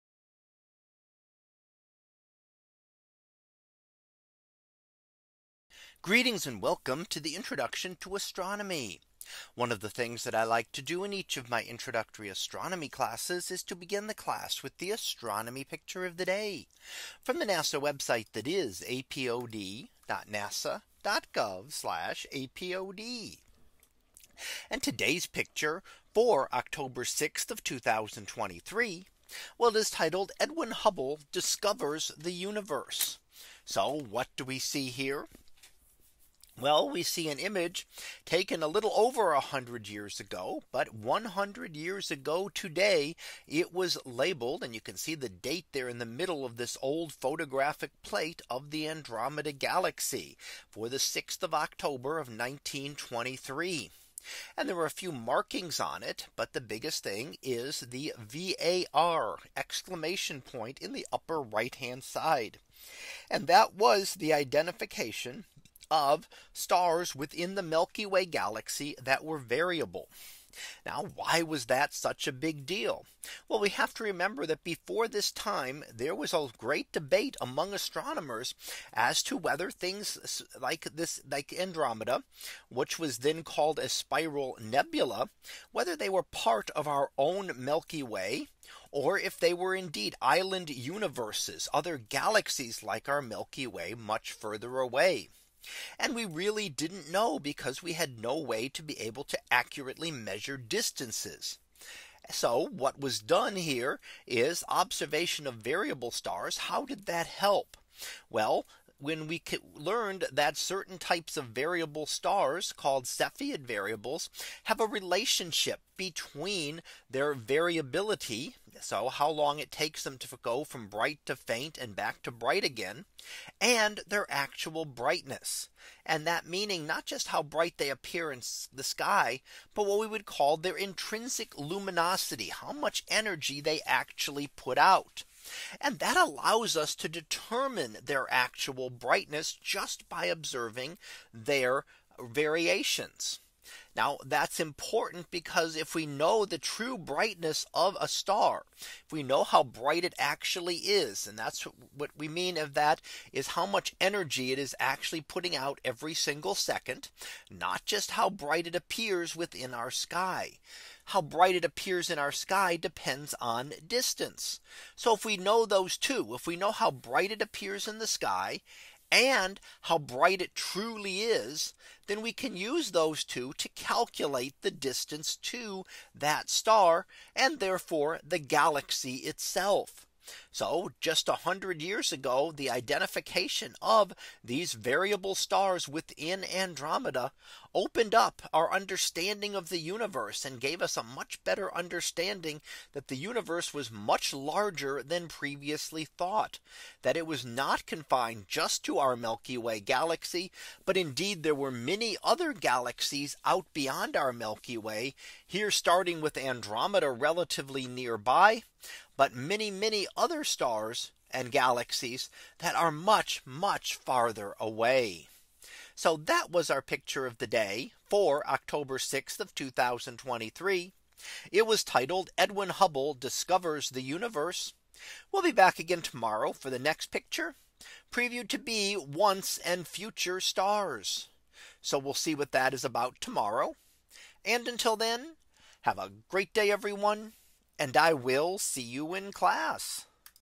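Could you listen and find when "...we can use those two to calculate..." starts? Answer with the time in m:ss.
2:52.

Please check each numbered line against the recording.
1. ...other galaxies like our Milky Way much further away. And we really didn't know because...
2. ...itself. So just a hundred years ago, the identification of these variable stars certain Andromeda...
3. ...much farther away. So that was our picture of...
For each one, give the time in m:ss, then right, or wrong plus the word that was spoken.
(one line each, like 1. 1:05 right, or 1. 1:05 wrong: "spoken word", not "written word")
1. 1:31 right
2. 2:59 wrong: "within", not "certain"
3. 3:33 right.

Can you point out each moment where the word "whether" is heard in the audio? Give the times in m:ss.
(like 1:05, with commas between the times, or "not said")
1:19, 1:25.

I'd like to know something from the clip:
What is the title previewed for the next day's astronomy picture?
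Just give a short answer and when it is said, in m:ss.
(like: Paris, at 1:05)
Once and future stars, at 3:48.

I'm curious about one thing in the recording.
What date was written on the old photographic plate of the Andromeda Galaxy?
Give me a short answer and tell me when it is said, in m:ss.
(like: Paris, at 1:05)
6 October 1923, at 0:50.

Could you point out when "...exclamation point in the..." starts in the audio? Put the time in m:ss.
0:59.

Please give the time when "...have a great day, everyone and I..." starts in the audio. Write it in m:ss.
3:55.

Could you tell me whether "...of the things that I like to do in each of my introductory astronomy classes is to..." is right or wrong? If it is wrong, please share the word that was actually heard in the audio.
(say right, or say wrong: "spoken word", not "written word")
right.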